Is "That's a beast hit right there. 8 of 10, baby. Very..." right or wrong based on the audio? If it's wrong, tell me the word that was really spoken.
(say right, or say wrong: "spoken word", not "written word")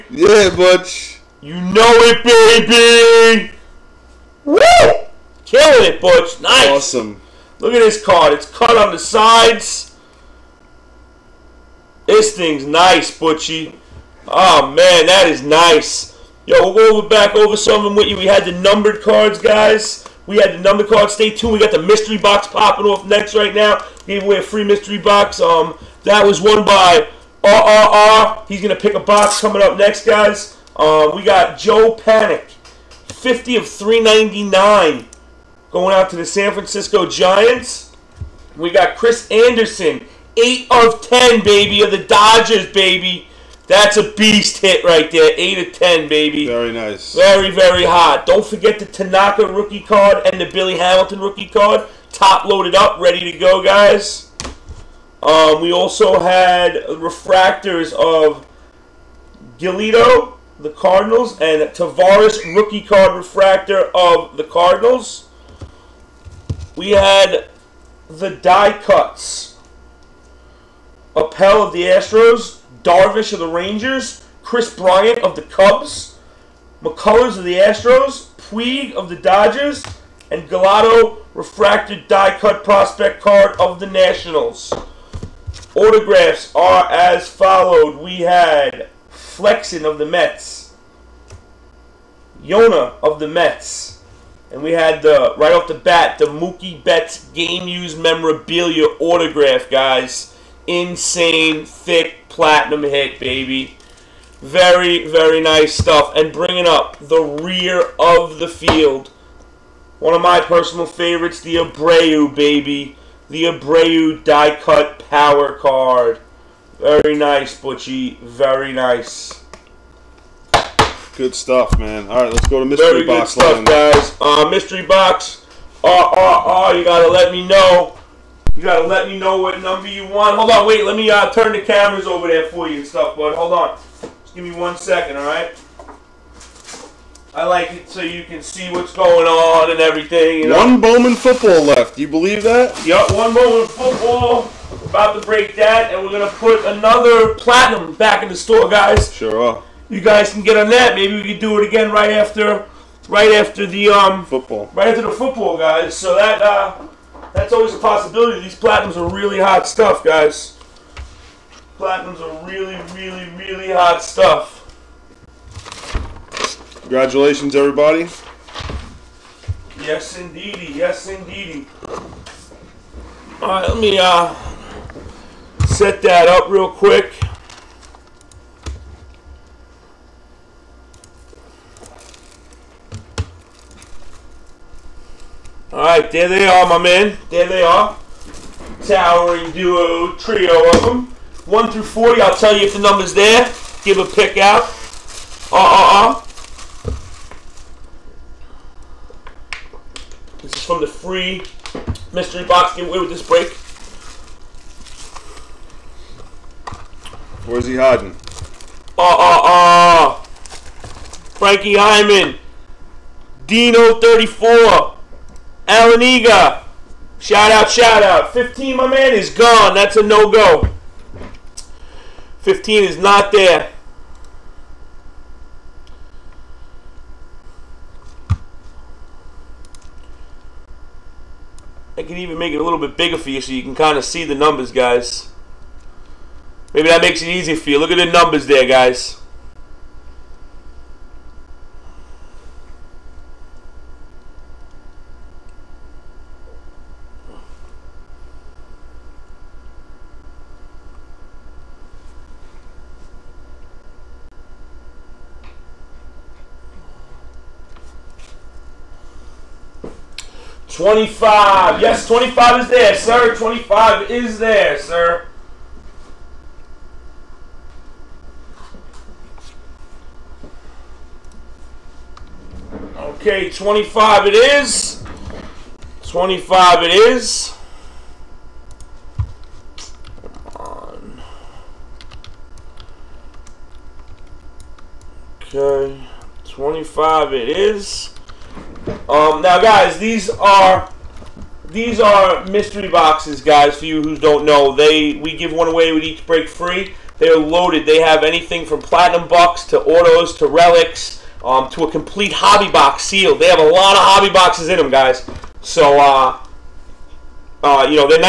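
right.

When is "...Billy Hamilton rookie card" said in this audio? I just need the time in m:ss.
0:50.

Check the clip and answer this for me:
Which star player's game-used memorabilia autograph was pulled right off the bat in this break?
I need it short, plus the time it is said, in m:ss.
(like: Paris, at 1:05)
Mookie Betts, at 1:36.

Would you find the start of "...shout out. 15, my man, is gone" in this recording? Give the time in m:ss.
3:37.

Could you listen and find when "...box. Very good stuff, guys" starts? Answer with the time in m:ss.
2:03.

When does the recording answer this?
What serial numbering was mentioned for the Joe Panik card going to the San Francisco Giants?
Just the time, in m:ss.
0:33.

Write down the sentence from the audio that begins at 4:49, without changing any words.
Um, now, guys, these are these are mystery boxes, guys.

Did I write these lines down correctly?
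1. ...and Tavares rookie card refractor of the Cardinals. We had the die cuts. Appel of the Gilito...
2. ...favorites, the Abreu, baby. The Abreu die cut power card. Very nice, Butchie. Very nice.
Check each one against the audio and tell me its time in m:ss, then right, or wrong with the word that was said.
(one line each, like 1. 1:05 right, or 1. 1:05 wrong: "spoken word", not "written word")
1. 1:01 wrong: "Astros", not "Gilito"
2. 1:50 right.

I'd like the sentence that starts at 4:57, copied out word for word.
They have anything from platinum bucks to autos to relics um, to a complete hobby box sealed.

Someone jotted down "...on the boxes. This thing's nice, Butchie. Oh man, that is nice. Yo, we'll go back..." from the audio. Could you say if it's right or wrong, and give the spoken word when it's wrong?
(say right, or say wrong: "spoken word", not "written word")
wrong: "sides", not "boxes".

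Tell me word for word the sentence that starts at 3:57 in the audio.
Look at the numbers there, guys.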